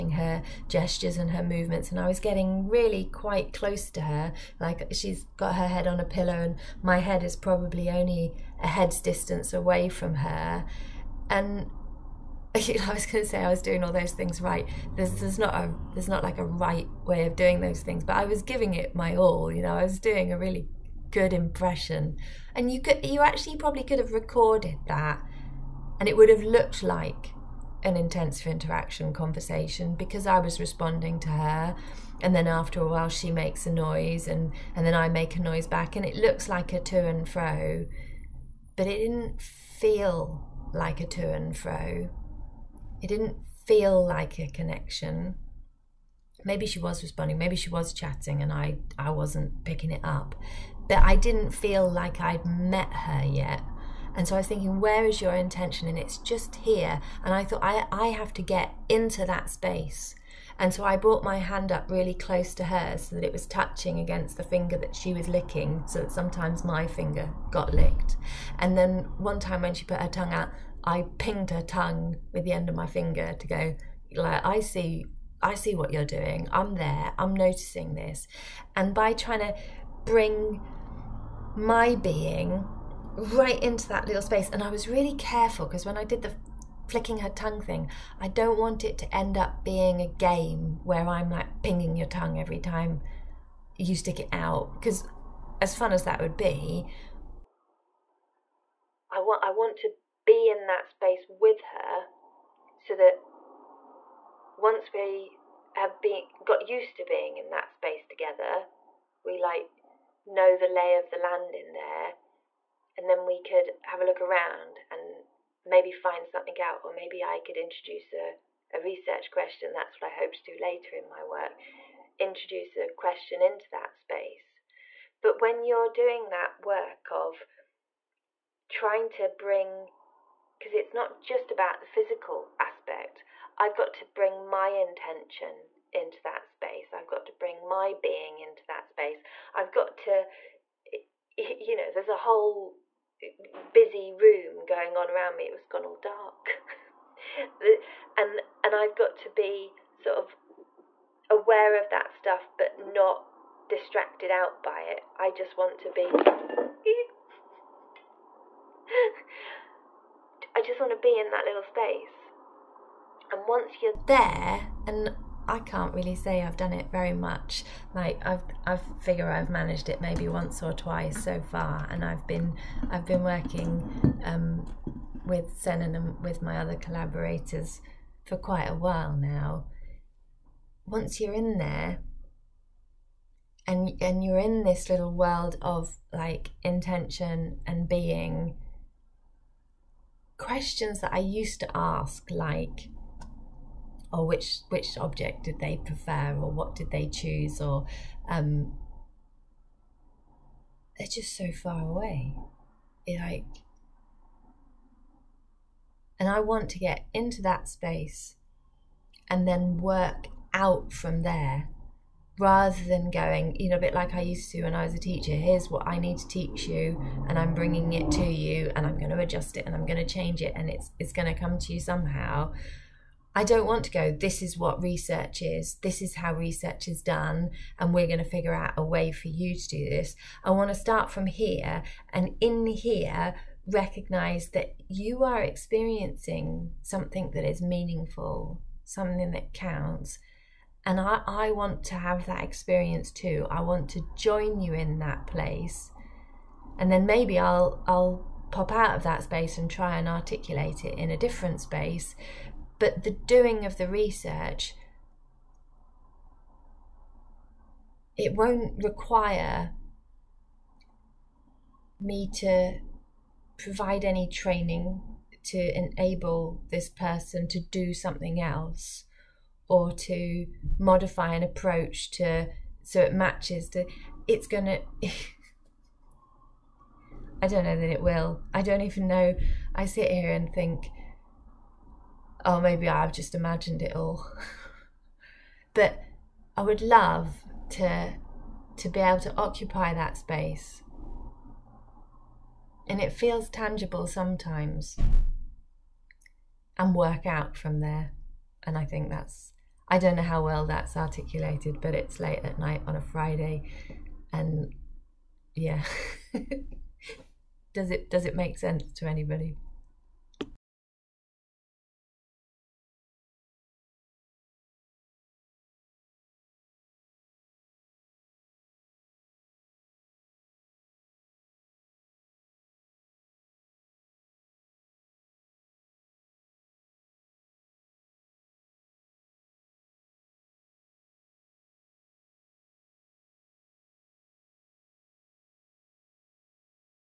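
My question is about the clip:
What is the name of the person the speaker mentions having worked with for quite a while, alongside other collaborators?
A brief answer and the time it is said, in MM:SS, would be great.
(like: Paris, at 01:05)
Sennen, at 02:55.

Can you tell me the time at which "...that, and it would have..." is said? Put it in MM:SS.
00:24.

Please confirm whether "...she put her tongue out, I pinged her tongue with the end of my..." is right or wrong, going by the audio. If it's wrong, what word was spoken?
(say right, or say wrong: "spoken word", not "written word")
right.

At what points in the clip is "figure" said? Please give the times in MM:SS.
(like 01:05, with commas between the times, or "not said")
02:48, 03:48.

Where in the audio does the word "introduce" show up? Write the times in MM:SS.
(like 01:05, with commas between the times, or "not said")
01:57, 02:02.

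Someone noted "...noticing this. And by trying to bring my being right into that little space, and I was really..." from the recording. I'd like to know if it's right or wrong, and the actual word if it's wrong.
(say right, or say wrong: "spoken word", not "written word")
right.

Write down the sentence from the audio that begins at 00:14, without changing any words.
There's, there's not a there's not like a right way of doing those things, but I was giving it my all.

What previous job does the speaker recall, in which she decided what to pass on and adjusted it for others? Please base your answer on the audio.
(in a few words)
teacher.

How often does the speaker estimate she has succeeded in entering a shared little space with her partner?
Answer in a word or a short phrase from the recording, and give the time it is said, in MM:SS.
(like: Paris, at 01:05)
once or twice, at 02:50.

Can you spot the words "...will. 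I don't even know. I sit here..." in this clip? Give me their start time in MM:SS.
04:38.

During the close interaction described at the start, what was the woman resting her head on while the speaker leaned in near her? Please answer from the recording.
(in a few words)
pillow.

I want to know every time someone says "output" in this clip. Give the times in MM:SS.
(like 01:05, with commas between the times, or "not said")
not said.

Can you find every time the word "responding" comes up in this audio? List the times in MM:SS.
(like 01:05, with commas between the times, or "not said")
00:30, 00:47.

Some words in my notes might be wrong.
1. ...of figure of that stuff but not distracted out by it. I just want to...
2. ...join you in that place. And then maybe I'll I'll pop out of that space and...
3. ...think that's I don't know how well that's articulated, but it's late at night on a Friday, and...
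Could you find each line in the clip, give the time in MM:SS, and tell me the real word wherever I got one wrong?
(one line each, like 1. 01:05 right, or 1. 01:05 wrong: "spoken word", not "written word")
1. 02:30 wrong: "aware", not "figure"
2. 04:04 right
3. 04:58 right.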